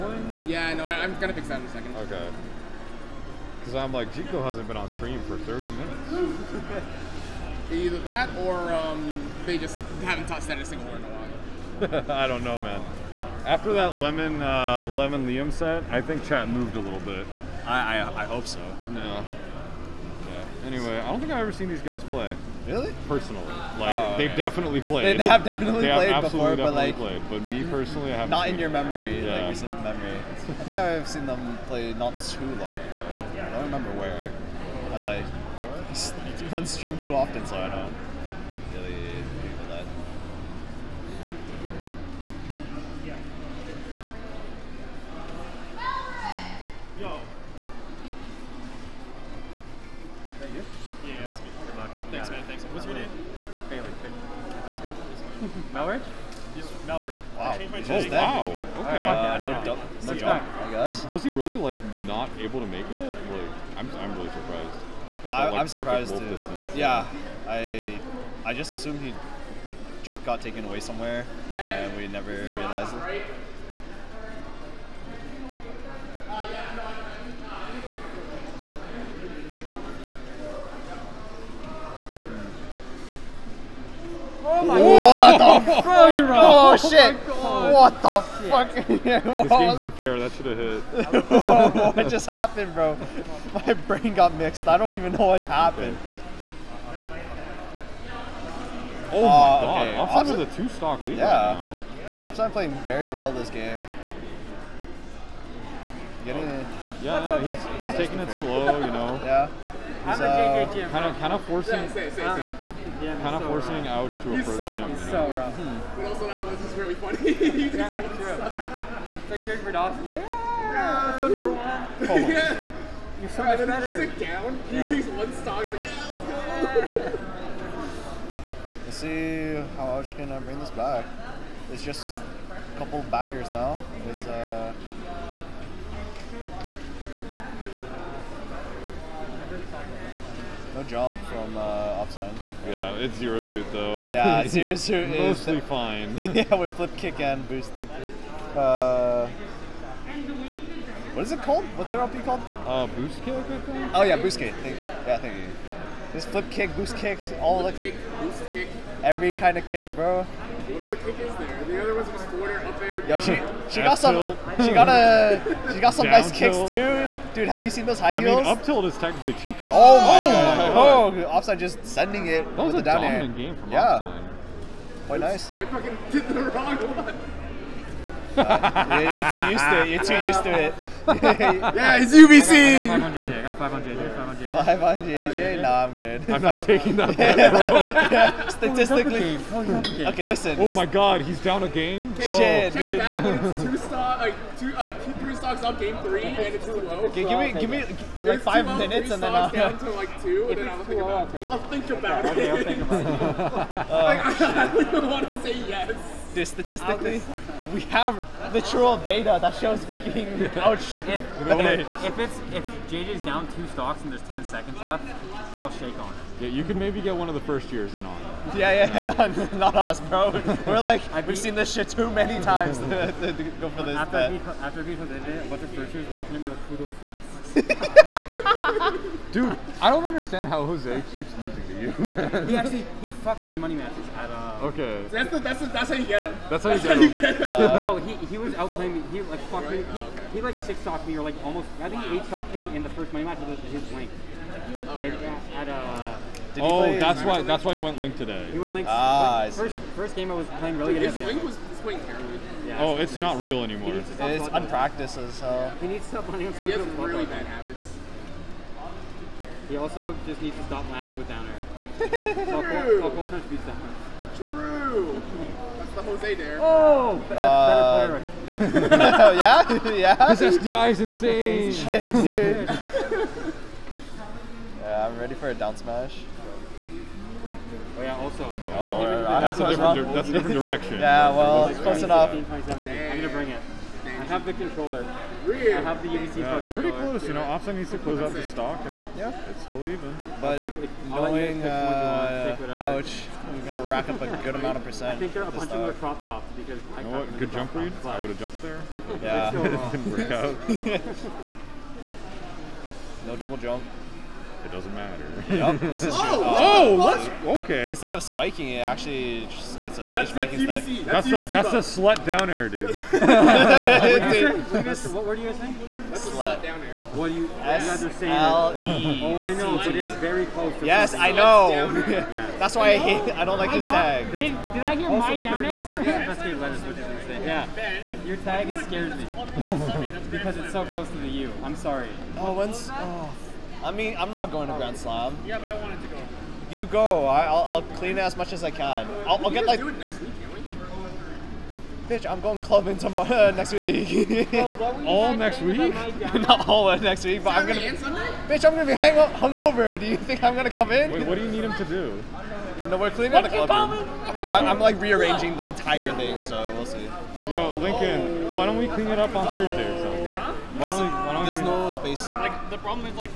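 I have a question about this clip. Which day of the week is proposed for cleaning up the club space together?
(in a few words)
Thursday.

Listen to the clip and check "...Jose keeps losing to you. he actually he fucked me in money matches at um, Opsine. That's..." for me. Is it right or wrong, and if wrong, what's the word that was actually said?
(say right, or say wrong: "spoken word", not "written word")
wrong: "Okay", not "Opsine".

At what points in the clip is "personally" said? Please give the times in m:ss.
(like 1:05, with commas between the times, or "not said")
0:23, 0:27.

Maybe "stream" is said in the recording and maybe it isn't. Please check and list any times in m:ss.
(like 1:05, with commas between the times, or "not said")
0:04, 0:36.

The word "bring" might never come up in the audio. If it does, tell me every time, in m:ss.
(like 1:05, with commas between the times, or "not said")
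2:10, 4:43.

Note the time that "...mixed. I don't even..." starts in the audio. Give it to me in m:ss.
1:34.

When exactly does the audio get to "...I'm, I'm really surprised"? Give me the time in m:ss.
1:03.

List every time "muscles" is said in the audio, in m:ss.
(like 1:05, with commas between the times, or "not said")
not said.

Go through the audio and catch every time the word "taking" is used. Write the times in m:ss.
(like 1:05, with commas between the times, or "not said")
1:47, 3:06.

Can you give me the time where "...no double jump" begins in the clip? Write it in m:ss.
5:03.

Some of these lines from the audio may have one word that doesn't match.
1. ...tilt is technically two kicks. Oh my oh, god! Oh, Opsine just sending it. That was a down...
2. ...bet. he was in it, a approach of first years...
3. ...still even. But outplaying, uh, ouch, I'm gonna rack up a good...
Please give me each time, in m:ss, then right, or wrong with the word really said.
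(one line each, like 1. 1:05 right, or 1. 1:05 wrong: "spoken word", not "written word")
1. 2:48 right
2. 3:44 wrong: "bunch", not "approach"
3. 4:49 wrong: "knowing", not "outplaying".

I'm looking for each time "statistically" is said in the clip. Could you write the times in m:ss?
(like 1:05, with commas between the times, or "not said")
3:08, 3:26.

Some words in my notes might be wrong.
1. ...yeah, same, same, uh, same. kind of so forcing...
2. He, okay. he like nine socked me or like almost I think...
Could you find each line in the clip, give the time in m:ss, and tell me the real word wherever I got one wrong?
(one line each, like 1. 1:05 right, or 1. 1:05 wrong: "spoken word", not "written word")
1. 1:51 right
2. 3:59 wrong: "six", not "nine".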